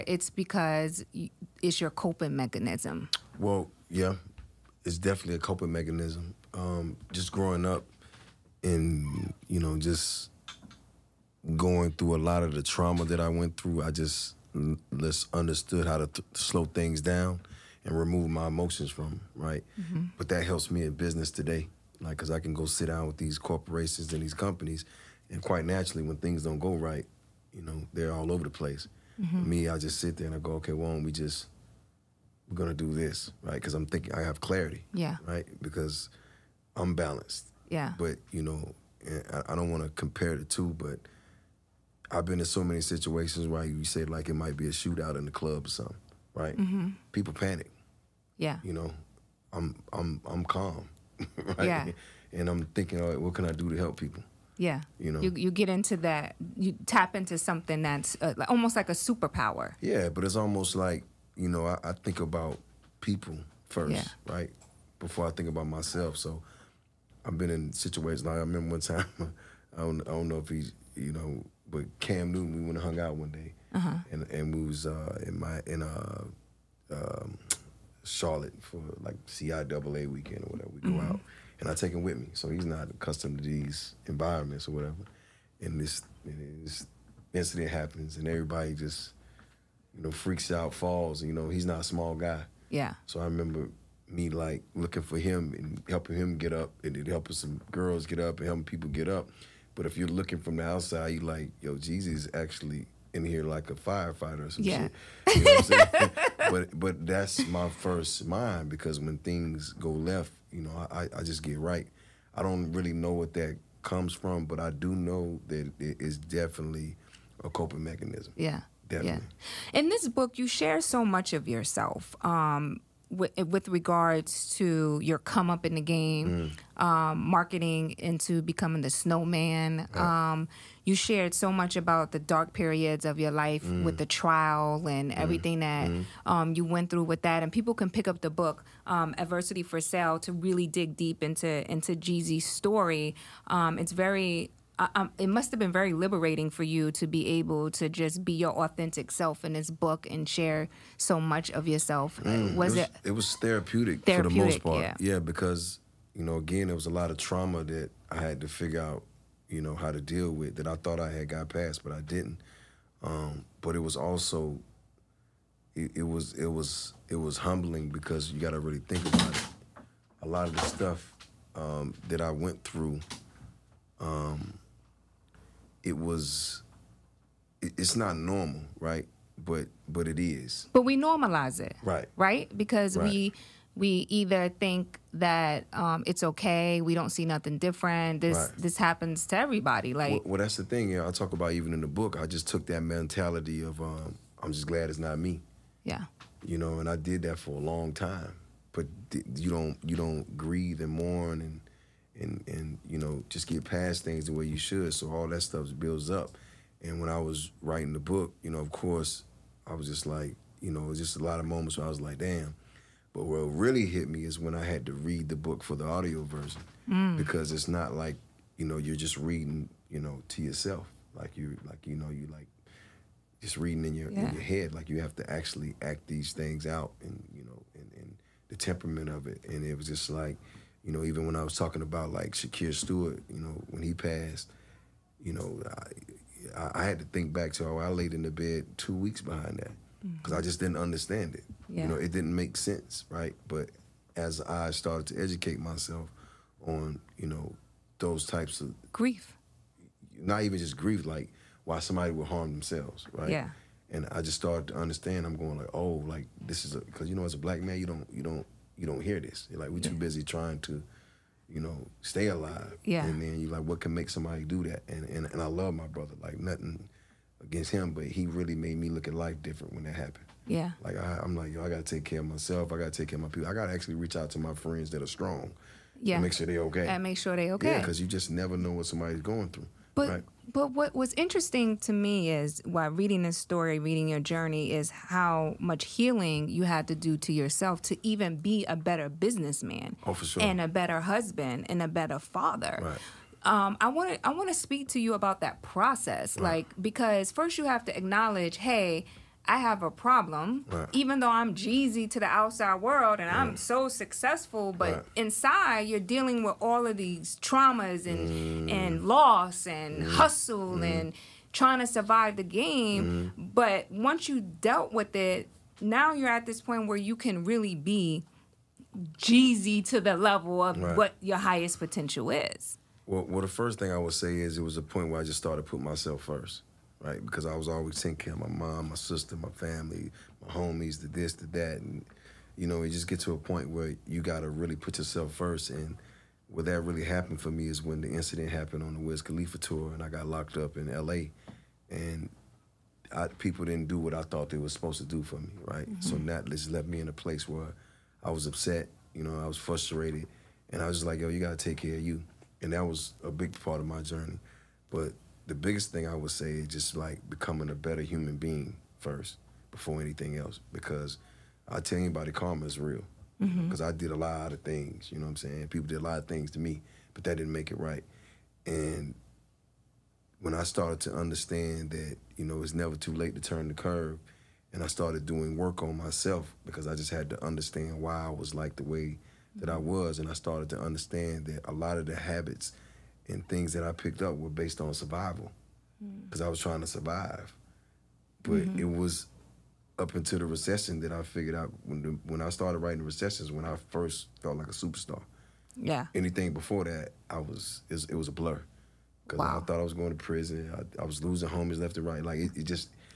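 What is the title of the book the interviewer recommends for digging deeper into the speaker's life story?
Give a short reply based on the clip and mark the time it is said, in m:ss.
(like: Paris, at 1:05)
Adversity for Sale, at 2:19.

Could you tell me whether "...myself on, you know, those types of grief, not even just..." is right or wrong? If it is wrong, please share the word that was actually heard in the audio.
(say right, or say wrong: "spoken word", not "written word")
right.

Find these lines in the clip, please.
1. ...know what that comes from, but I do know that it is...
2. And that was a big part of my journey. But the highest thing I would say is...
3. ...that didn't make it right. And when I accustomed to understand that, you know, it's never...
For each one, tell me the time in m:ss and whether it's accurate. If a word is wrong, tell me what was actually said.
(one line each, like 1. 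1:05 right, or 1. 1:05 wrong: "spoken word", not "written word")
1. 1:52 right
2. 5:52 wrong: "biggest", not "highest"
3. 6:07 wrong: "started", not "accustomed".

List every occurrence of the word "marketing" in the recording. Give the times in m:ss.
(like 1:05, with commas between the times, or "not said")
2:07.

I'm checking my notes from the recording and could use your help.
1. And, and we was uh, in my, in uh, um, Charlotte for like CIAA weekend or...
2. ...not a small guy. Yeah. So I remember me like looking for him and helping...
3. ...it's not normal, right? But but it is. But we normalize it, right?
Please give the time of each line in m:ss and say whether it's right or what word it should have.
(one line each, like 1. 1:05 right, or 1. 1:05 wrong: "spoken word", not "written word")
1. 1:14 right
2. 1:31 right
3. 2:57 right.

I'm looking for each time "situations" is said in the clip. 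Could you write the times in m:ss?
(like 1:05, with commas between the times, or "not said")
0:42, 1:07.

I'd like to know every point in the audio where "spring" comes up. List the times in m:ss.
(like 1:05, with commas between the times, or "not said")
not said.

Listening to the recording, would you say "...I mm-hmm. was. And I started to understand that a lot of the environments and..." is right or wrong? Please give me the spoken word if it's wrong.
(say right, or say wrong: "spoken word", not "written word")
wrong: "habits", not "environments".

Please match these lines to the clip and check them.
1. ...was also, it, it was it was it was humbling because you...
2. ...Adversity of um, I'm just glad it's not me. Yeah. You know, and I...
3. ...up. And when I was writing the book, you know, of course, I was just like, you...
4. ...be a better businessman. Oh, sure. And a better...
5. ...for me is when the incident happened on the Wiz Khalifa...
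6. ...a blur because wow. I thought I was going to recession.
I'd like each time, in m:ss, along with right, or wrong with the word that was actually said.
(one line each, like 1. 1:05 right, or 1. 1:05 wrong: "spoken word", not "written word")
1. 2:43 right
2. 3:12 wrong: "mentality", not "Adversity"
3. 3:26 right
4. 4:48 right
5. 5:37 right
6. 6:38 wrong: "prison", not "recession".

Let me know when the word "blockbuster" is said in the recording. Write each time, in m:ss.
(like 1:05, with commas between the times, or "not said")
not said.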